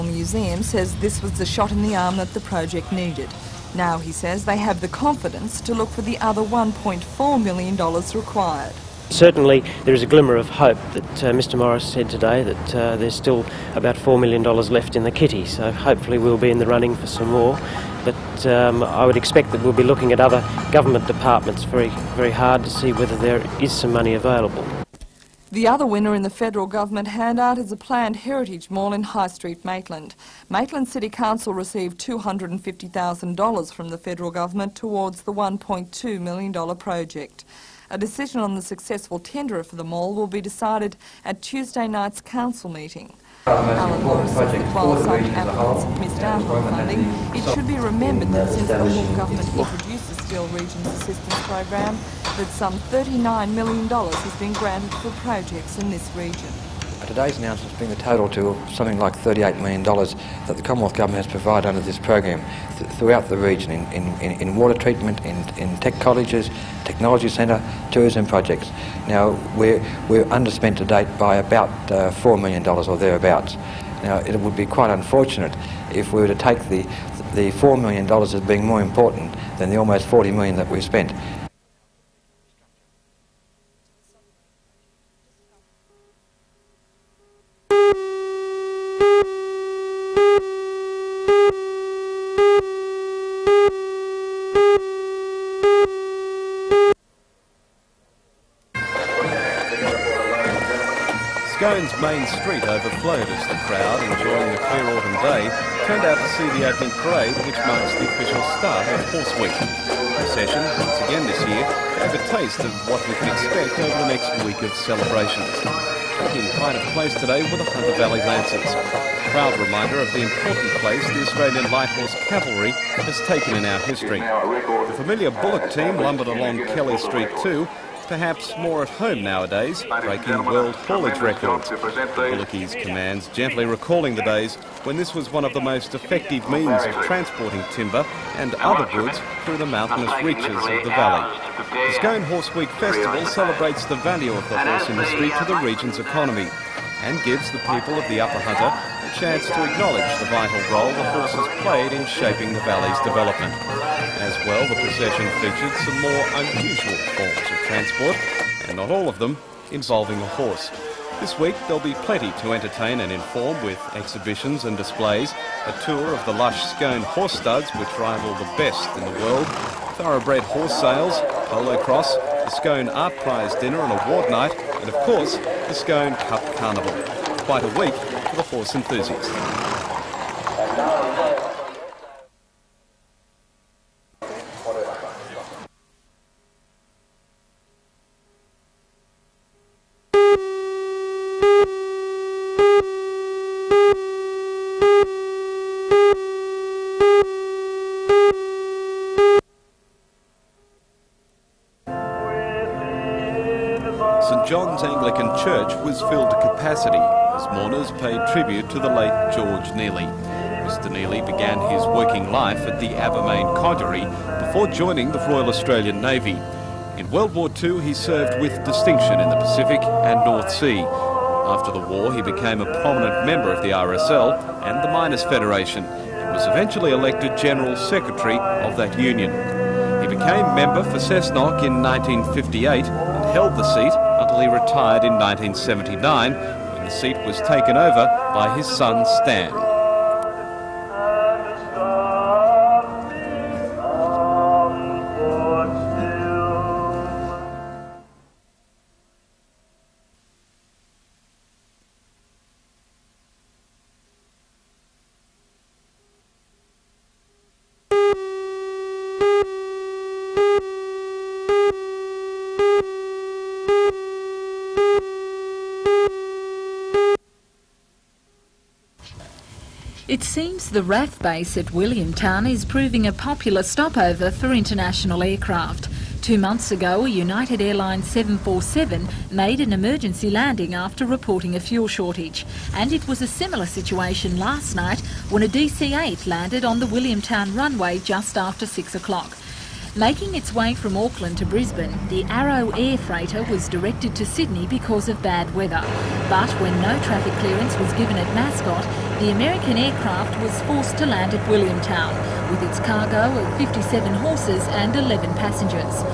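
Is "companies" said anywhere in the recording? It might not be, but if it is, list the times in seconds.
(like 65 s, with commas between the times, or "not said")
not said.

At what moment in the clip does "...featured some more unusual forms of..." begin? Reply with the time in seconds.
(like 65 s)
155 s.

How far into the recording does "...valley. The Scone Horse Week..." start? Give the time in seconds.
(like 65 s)
140 s.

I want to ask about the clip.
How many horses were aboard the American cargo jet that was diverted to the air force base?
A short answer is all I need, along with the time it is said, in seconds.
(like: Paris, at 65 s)
57, at 303 s.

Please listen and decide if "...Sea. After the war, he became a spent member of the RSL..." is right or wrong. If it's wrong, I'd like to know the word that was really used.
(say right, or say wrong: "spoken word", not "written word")
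wrong: "prominent", not "spent".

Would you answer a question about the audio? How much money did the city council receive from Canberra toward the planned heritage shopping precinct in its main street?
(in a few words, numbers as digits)
$250,000.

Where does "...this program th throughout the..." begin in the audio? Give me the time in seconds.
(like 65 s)
61 s.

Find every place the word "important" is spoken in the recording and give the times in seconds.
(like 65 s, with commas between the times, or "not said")
78 s, 120 s.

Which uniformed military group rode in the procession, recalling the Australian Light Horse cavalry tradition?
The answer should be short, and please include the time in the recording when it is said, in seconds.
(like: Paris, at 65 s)
Hunter Valley Lancers, at 117 s.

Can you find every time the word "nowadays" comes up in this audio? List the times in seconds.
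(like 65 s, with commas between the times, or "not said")
129 s.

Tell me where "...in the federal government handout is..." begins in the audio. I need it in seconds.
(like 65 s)
26 s.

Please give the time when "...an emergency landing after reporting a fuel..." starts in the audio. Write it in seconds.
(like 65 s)
279 s.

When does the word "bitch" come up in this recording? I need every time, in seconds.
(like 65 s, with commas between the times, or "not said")
not said.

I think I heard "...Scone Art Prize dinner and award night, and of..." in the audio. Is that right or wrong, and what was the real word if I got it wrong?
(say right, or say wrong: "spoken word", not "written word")
right.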